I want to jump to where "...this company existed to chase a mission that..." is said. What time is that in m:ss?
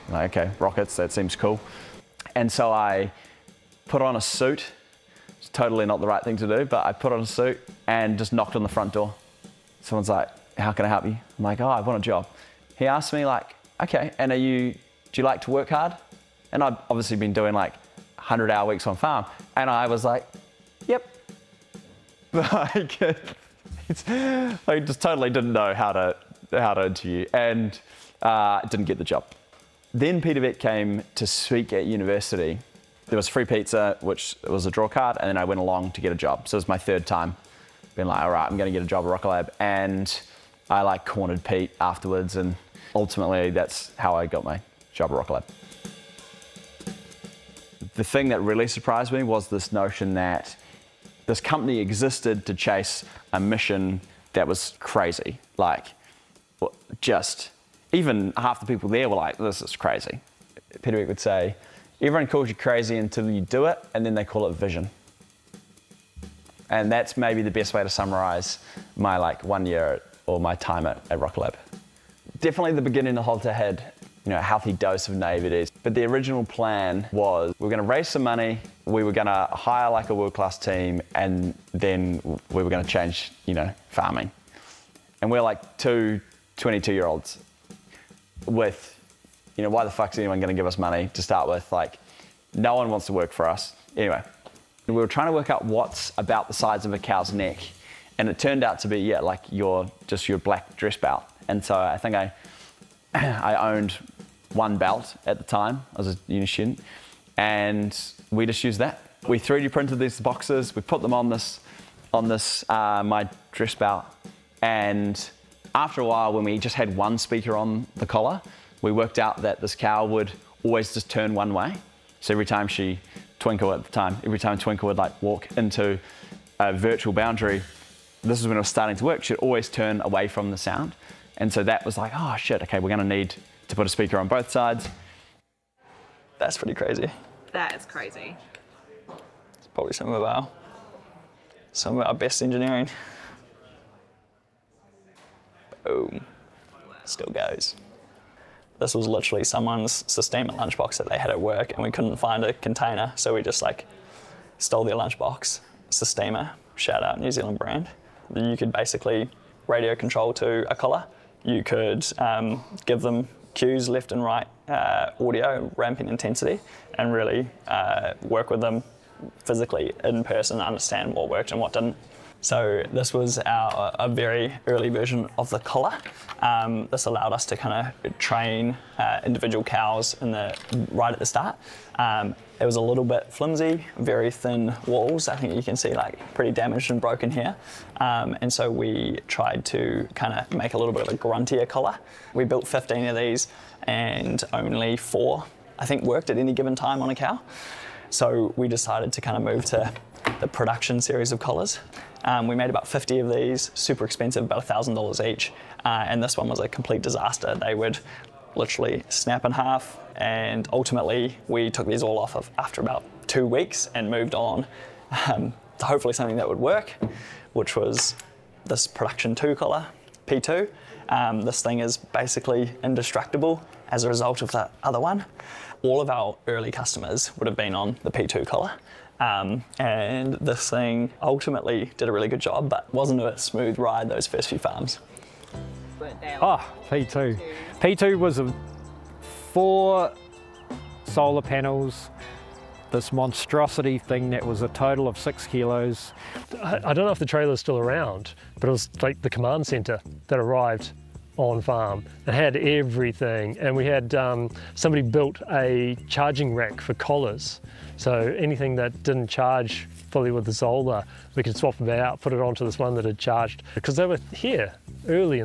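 0:51.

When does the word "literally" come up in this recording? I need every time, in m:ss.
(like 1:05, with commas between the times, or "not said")
2:29, 3:28.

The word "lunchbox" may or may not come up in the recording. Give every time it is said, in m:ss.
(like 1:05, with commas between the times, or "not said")
2:30, 2:34.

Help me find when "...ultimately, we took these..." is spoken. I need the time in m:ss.
3:30.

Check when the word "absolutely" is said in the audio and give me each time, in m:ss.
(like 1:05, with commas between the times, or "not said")
not said.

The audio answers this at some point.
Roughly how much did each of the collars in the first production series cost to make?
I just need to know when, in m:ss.
3:24.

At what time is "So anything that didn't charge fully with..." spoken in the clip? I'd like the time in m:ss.
4:17.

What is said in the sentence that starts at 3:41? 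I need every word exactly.
Um, this thing is basically indestructible as a result of that other one.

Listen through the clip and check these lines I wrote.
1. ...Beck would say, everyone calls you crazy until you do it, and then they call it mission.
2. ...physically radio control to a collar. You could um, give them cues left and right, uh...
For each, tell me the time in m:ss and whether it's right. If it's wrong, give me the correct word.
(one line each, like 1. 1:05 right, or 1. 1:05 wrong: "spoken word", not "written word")
1. 1:00 wrong: "vision", not "mission"
2. 2:38 wrong: "basically", not "physically".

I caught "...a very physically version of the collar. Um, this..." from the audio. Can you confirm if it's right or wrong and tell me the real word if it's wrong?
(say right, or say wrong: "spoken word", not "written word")
wrong: "early", not "physically".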